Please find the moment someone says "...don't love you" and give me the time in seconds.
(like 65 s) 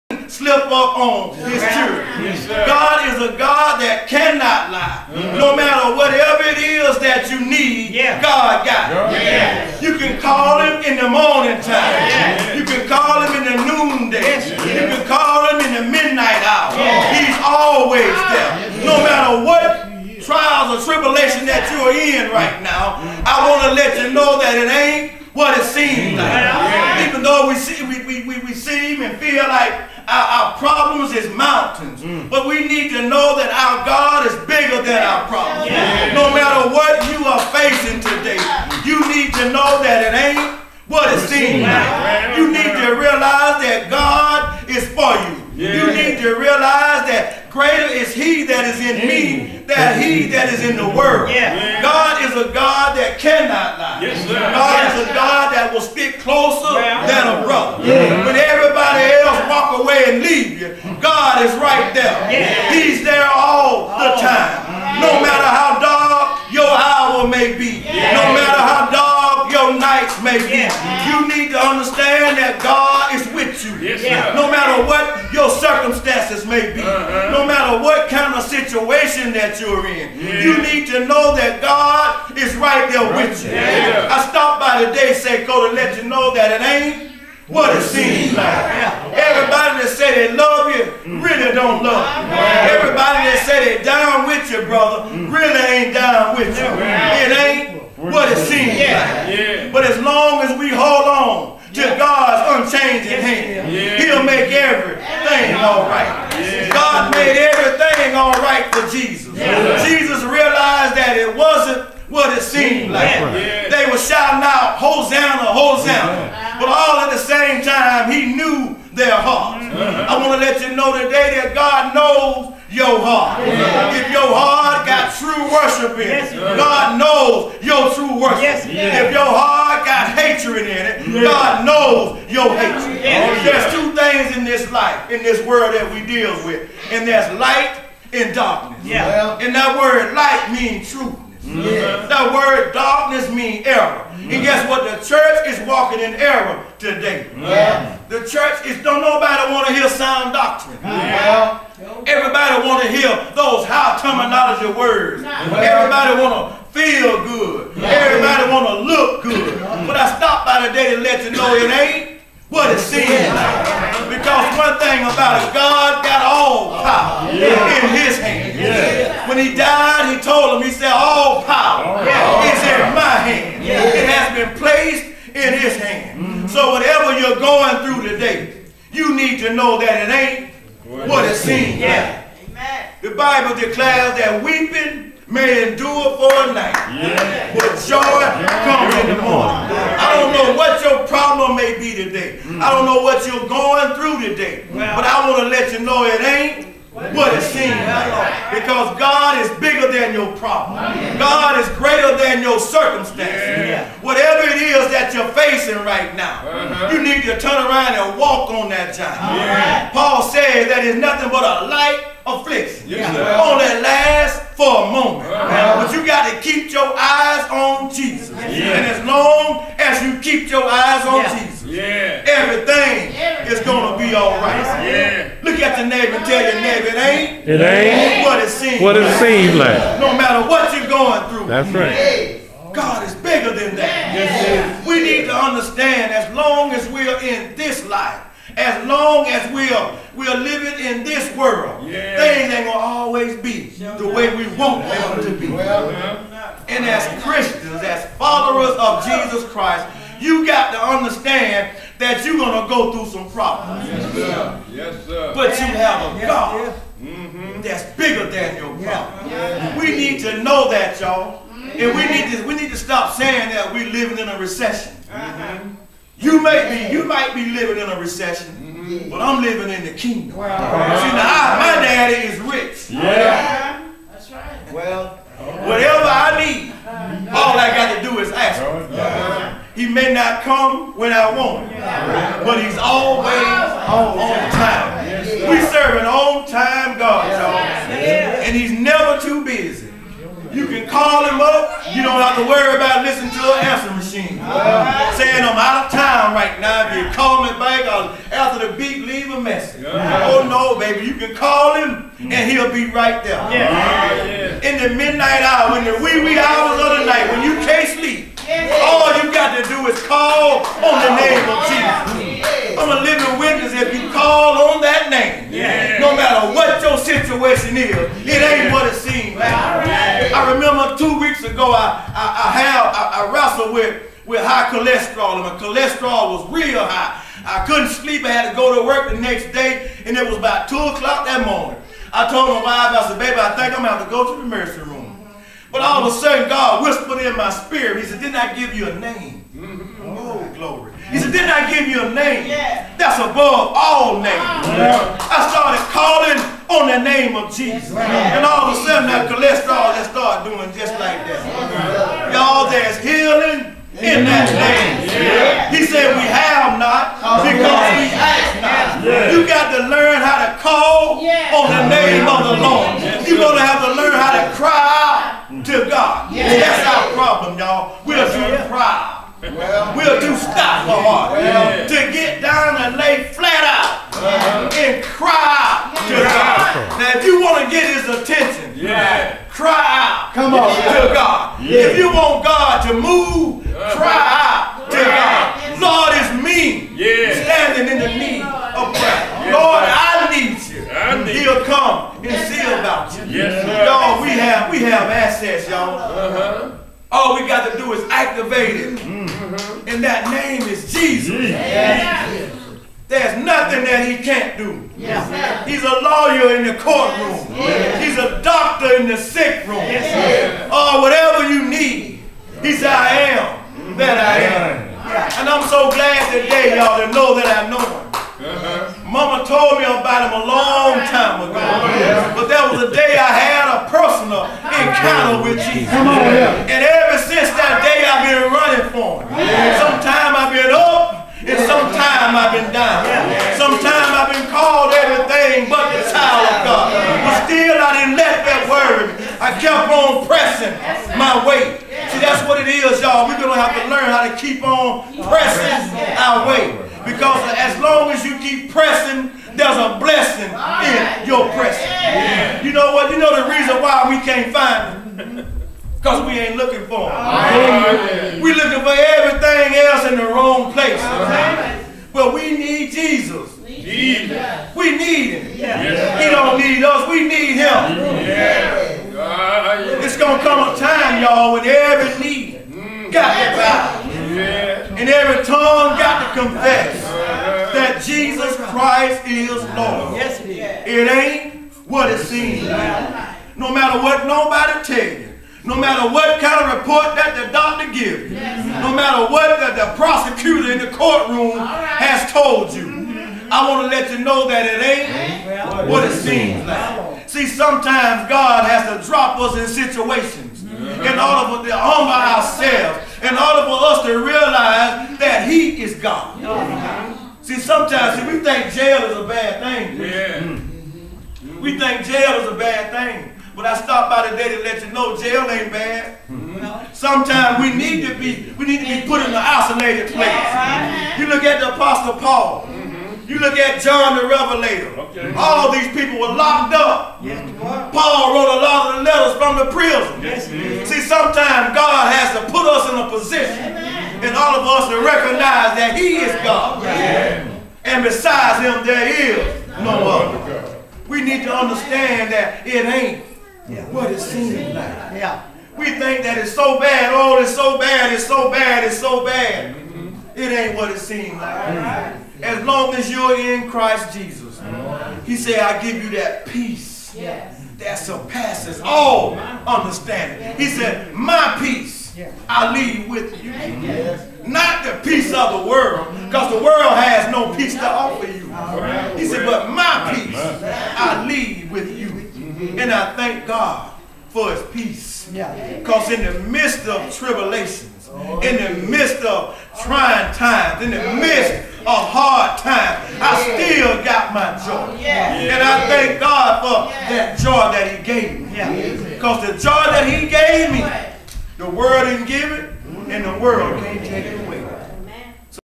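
91 s.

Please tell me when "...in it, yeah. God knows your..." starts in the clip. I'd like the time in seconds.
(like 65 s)
130 s.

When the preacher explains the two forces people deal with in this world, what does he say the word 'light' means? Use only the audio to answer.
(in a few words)
truth.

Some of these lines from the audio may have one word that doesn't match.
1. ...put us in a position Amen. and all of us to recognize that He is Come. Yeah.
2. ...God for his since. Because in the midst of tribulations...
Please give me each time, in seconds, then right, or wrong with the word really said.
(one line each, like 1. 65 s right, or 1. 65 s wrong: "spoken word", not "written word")
1. 532 s wrong: "God", not "Come"
2. 573 s wrong: "peace", not "since".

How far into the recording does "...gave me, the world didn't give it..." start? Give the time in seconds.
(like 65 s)
590 s.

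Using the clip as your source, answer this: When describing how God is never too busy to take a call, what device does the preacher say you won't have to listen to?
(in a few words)
answer machine.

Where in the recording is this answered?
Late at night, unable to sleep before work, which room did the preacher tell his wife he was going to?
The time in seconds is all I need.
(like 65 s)
334 s.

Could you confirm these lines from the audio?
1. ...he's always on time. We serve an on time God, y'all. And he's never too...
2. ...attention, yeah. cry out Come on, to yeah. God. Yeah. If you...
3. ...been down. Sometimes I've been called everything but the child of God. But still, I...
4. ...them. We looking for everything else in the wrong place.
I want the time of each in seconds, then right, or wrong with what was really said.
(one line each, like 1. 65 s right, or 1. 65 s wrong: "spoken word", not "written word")
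1. 282 s right
2. 378 s right
3. 432 s right
4. 457 s right.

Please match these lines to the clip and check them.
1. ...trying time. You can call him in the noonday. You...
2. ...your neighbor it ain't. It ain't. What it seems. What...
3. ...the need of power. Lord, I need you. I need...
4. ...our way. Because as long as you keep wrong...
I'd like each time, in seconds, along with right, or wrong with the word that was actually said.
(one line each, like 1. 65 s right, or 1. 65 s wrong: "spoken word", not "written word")
1. 11 s wrong: "morning", not "trying"
2. 226 s right
3. 387 s wrong: "prayer", not "power"
4. 446 s wrong: "pressing", not "wrong".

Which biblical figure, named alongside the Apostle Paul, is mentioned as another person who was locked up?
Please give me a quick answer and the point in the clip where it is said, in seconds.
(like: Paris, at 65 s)
John the Revelator, at 523 s.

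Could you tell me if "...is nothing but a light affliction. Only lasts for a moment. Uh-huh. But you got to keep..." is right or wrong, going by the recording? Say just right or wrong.
right.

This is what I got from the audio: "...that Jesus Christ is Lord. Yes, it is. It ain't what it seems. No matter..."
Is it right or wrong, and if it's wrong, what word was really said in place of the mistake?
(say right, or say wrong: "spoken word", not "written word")
right.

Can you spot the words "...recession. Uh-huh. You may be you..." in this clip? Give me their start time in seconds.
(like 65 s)
264 s.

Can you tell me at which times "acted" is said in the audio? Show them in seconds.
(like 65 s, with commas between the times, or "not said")
not said.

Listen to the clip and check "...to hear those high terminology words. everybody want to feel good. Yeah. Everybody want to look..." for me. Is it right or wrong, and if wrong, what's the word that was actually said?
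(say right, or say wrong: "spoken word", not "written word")
right.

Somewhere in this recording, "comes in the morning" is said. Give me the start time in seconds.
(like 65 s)
188 s.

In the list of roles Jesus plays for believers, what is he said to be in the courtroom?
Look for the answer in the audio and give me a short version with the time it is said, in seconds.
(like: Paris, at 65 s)
a lawyer, at 405 s.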